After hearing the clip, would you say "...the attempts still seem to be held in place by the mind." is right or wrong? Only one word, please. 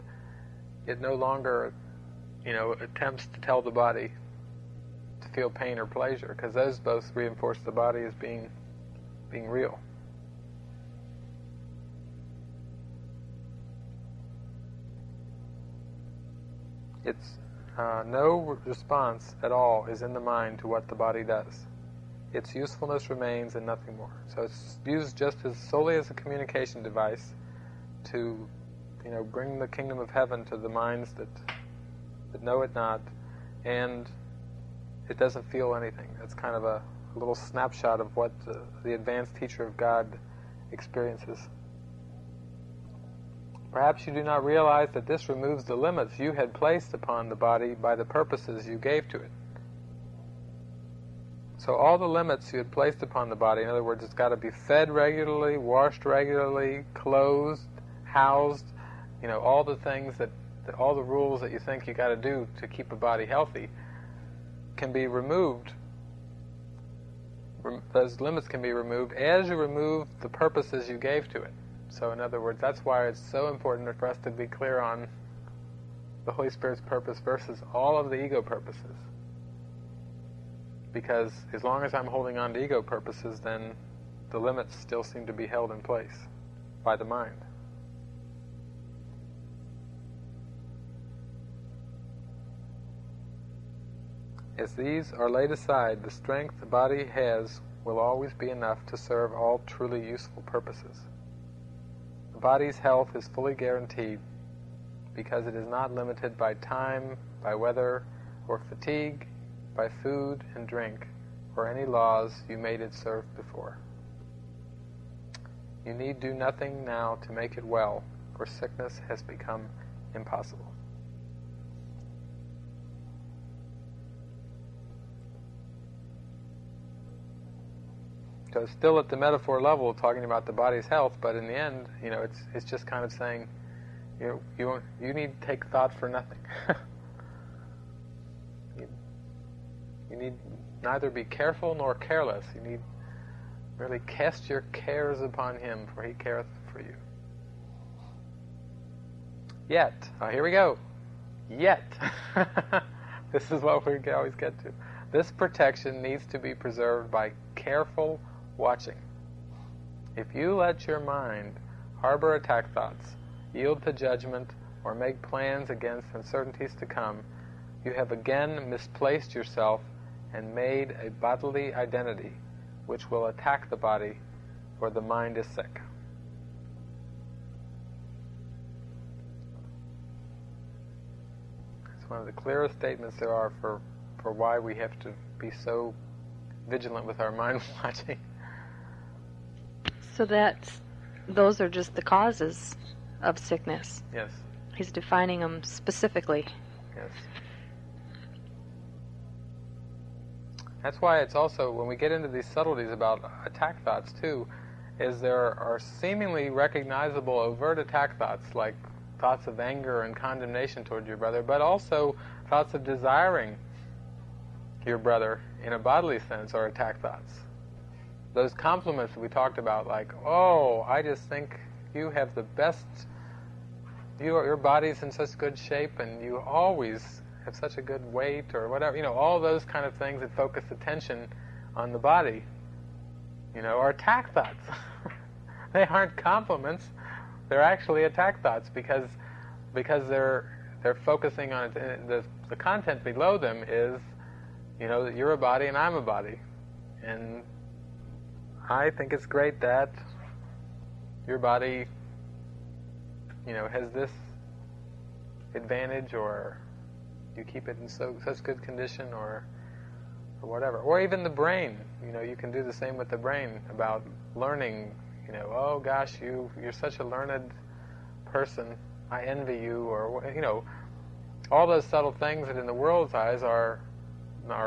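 wrong.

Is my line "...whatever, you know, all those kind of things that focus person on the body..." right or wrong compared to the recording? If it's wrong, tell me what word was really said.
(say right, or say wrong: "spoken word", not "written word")
wrong: "attention", not "person".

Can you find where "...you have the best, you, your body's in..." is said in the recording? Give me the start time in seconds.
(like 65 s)
221 s.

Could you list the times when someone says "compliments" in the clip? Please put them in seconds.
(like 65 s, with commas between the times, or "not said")
218 s, 236 s.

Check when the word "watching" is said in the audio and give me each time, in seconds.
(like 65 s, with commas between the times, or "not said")
158 s, 187 s.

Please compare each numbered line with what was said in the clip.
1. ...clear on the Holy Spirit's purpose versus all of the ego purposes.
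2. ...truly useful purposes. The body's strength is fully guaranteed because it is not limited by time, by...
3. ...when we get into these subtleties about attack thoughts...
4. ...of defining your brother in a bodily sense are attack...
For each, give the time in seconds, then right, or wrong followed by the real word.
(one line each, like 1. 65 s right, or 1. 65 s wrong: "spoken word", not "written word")
1. 74 s right
2. 99 s wrong: "health", not "strength"
3. 201 s right
4. 212 s wrong: "desiring", not "defining".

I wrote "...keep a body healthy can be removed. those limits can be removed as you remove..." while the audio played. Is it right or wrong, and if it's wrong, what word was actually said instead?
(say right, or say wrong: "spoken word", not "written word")
right.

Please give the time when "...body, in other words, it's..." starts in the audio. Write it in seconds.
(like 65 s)
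53 s.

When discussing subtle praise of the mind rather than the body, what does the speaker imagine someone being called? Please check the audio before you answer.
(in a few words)
a learned person.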